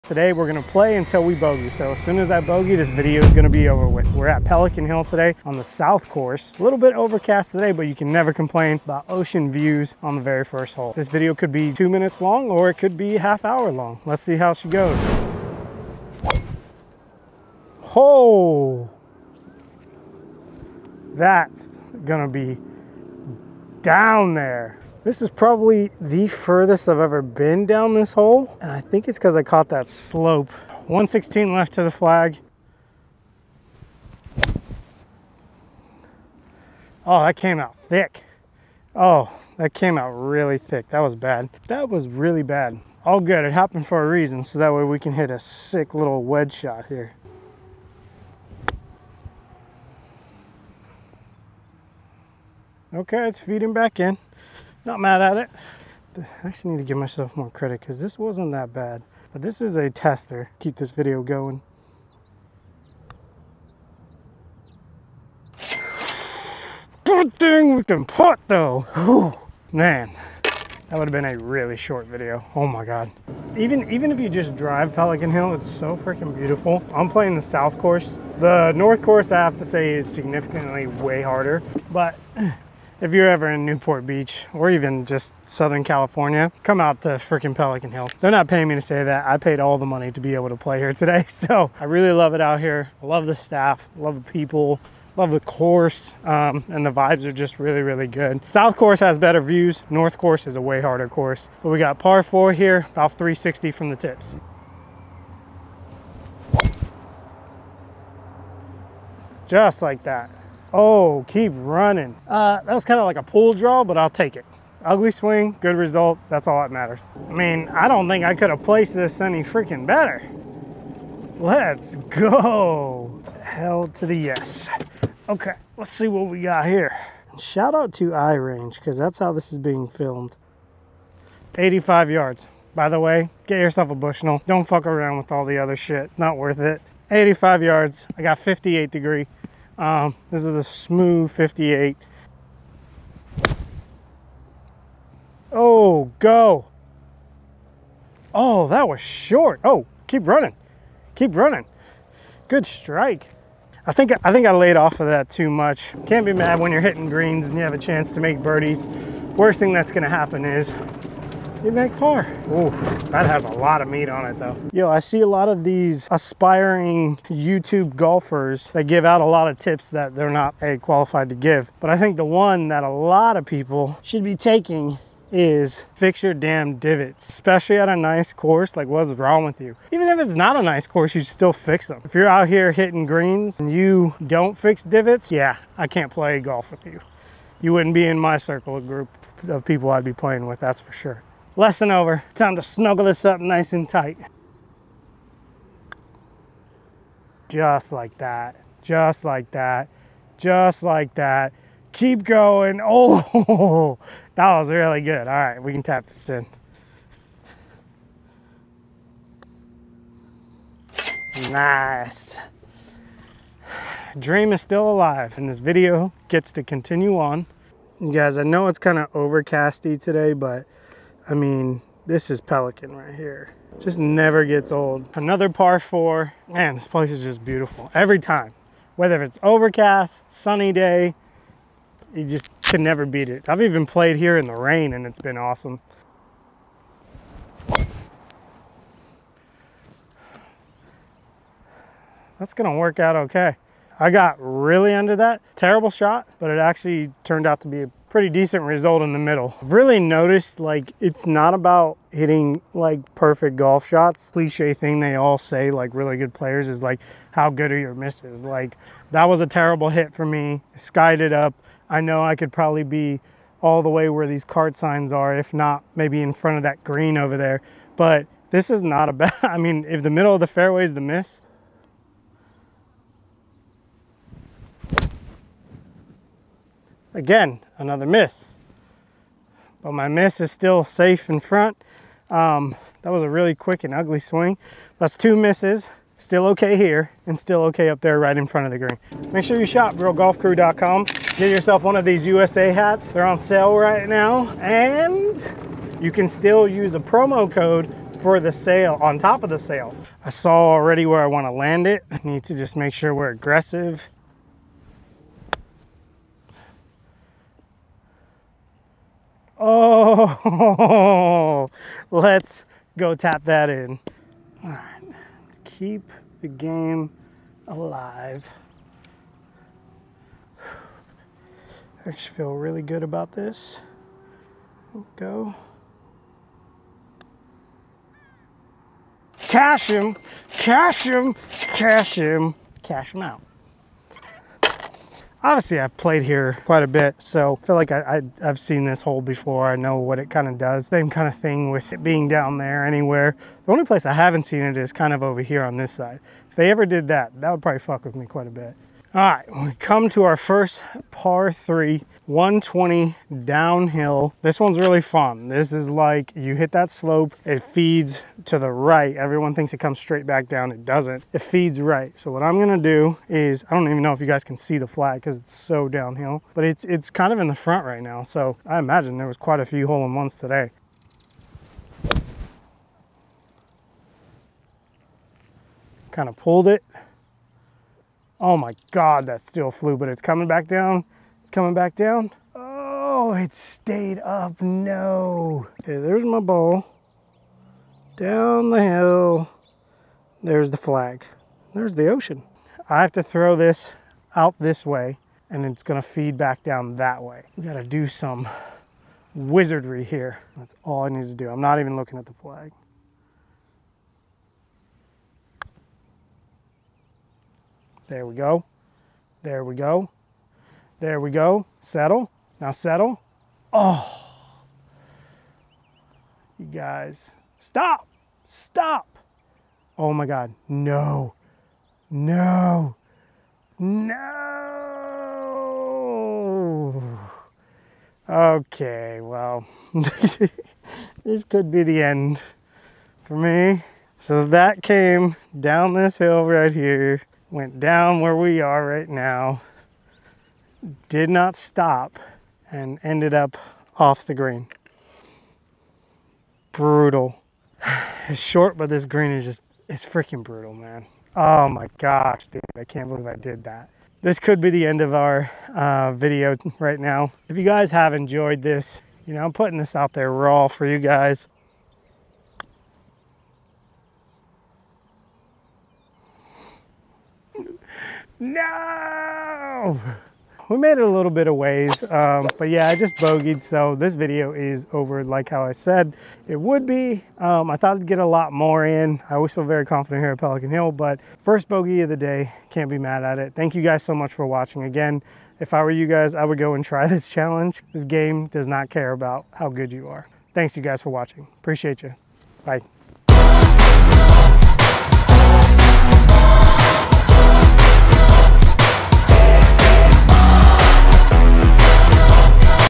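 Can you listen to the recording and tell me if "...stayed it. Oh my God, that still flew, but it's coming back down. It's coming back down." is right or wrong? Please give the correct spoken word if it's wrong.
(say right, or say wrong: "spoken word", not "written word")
wrong: "pulled", not "stayed".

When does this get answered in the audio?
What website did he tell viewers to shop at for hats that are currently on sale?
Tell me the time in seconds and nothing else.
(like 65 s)
289 s.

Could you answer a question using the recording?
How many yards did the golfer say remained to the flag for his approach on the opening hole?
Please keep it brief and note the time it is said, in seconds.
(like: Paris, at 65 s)
116, at 30 s.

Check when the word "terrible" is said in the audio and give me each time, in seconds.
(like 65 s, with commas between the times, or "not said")
245 s, 259 s.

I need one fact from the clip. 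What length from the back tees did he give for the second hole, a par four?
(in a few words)
360.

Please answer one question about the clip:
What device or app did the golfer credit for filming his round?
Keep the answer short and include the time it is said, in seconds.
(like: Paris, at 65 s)
iRange, at 128 s.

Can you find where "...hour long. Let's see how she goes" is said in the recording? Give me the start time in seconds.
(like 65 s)
13 s.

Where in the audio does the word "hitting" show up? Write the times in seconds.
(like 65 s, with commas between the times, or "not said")
156 s, 182 s, 252 s.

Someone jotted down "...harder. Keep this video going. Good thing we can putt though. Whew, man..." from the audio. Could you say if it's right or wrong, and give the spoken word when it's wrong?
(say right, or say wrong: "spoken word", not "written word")
wrong: "tester", not "harder".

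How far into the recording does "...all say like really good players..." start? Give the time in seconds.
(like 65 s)
255 s.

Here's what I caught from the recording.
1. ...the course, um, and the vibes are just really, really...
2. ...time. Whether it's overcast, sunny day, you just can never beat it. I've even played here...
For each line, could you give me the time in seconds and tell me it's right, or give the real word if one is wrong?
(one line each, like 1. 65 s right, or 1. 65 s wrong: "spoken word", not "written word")
1. 95 s right
2. 228 s right.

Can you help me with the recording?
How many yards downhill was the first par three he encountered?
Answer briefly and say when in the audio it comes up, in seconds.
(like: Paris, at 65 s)
120, at 352 s.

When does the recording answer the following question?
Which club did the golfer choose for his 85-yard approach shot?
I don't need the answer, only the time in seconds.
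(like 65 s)
138 s.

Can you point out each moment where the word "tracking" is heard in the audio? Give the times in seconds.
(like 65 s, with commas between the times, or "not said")
not said.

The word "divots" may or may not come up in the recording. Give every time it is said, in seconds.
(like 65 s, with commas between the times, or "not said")
176 s, 184 s.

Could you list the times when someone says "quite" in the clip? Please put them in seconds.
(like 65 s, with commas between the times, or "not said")
336 s, 348 s, 369 s.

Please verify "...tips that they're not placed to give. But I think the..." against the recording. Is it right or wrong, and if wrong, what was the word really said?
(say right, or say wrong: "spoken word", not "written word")
wrong: "qualified", not "placed".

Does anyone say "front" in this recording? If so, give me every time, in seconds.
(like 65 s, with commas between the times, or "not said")
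266 s, 281 s, 288 s, 367 s.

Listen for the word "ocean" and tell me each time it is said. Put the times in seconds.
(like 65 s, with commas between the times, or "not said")
9 s, 392 s.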